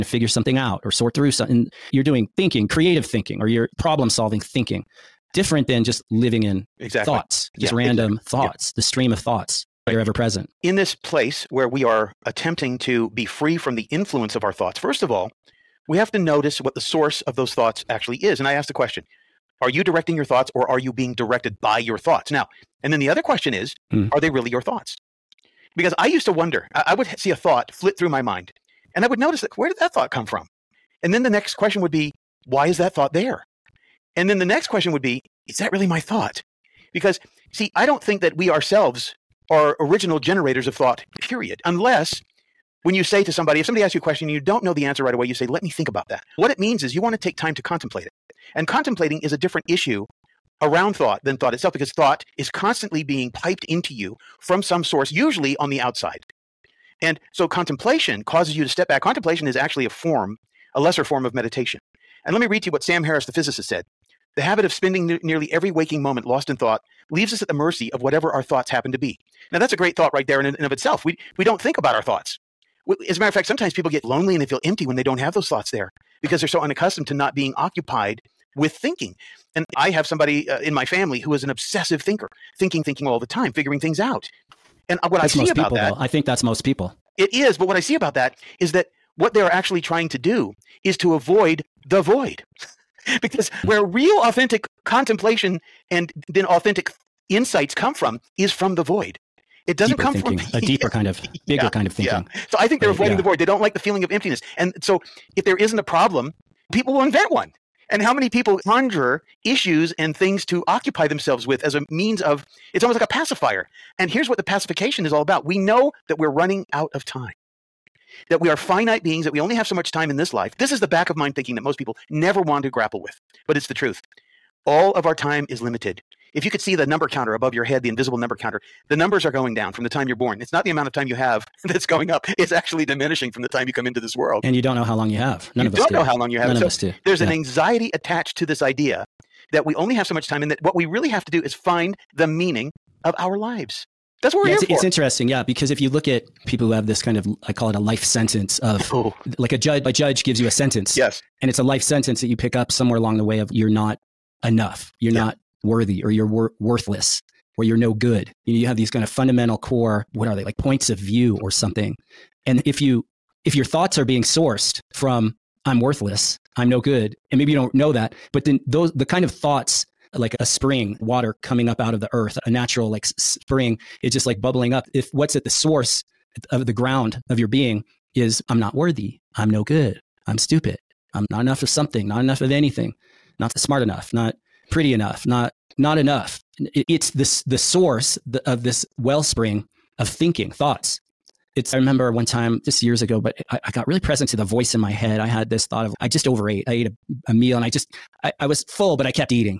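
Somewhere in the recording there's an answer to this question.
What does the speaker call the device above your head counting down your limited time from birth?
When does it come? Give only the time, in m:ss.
2:07.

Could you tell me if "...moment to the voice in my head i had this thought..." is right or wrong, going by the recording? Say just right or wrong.
wrong.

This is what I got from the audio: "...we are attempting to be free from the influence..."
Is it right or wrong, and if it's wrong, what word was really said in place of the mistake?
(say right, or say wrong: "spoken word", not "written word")
right.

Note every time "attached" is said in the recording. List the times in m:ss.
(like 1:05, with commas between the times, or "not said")
2:17.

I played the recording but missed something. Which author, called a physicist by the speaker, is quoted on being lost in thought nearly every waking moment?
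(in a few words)
Sam Harris.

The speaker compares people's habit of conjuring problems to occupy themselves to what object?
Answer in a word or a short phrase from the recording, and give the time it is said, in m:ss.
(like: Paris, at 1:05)
a pacifier, at 1:53.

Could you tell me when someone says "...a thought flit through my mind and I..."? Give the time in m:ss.
0:27.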